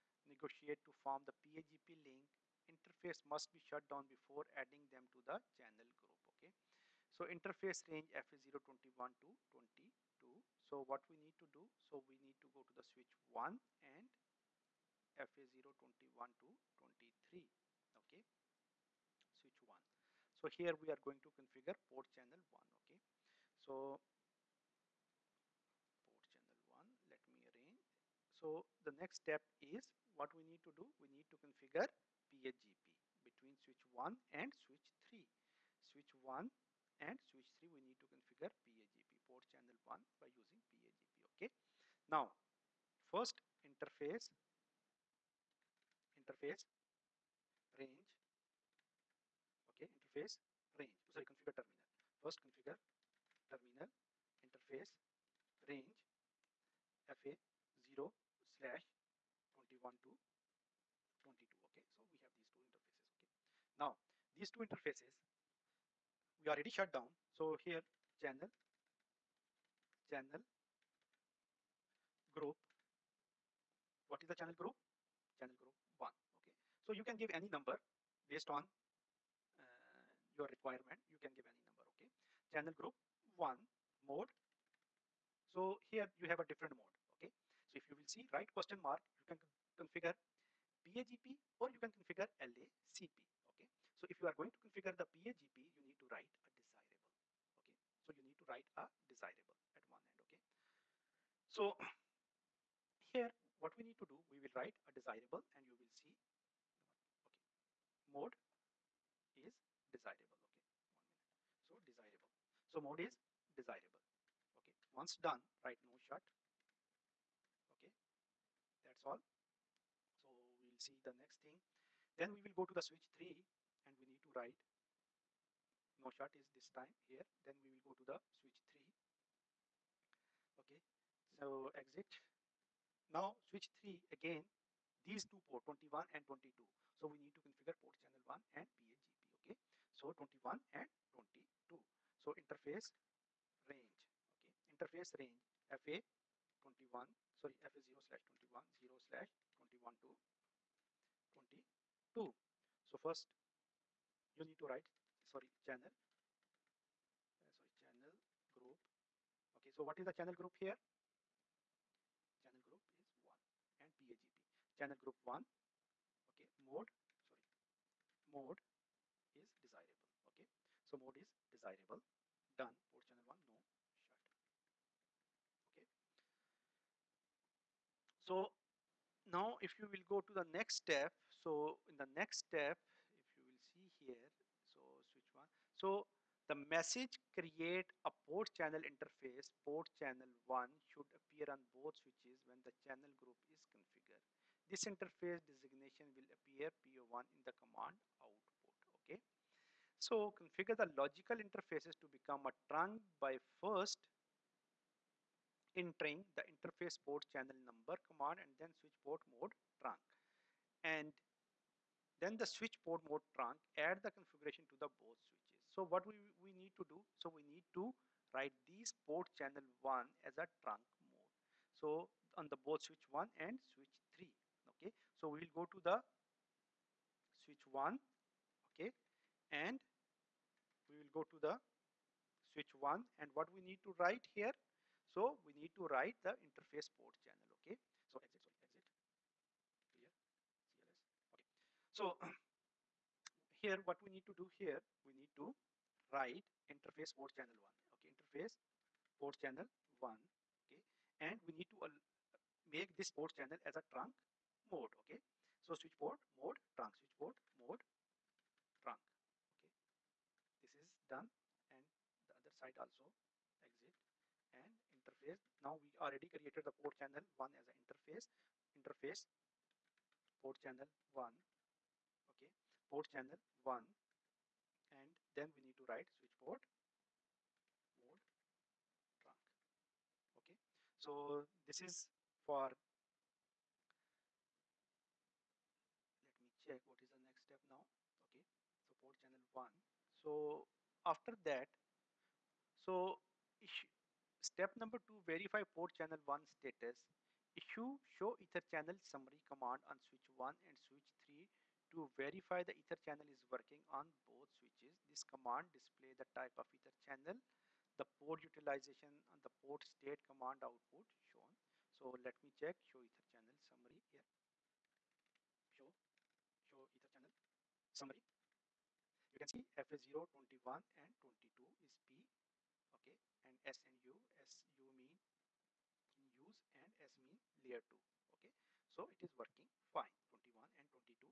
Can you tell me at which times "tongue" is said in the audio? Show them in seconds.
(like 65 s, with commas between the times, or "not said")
not said.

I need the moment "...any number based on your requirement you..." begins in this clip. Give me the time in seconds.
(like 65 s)
77 s.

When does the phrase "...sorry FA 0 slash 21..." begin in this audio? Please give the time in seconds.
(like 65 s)
147 s.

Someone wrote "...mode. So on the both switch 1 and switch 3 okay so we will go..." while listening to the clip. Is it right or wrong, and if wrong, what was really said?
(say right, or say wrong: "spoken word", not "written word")
right.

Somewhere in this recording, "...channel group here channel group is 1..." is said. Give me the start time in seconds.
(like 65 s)
160 s.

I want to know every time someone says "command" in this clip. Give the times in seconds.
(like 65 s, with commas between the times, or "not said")
197 s, 207 s, 299 s, 305 s, 310 s.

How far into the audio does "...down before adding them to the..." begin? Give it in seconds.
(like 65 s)
3 s.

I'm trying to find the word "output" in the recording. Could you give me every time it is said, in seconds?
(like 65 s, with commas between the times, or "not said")
198 s, 310 s.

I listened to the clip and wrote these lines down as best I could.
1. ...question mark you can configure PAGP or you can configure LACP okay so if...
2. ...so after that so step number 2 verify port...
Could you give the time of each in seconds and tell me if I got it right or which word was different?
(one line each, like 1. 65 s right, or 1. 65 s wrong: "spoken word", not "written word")
1. 88 s right
2. 290 s right.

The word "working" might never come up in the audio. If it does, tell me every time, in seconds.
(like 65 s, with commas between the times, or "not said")
303 s, 329 s.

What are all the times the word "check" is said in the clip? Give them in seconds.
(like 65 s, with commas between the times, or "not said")
286 s, 312 s.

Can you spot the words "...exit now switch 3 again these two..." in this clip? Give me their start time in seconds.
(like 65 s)
131 s.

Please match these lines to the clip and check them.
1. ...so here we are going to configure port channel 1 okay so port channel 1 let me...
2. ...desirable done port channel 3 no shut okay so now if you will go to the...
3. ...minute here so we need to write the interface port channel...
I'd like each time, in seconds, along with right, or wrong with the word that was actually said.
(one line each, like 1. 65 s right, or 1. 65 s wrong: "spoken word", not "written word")
1. 20 s right
2. 171 s wrong: "1", not "3"
3. 233 s wrong: "write", not "minute".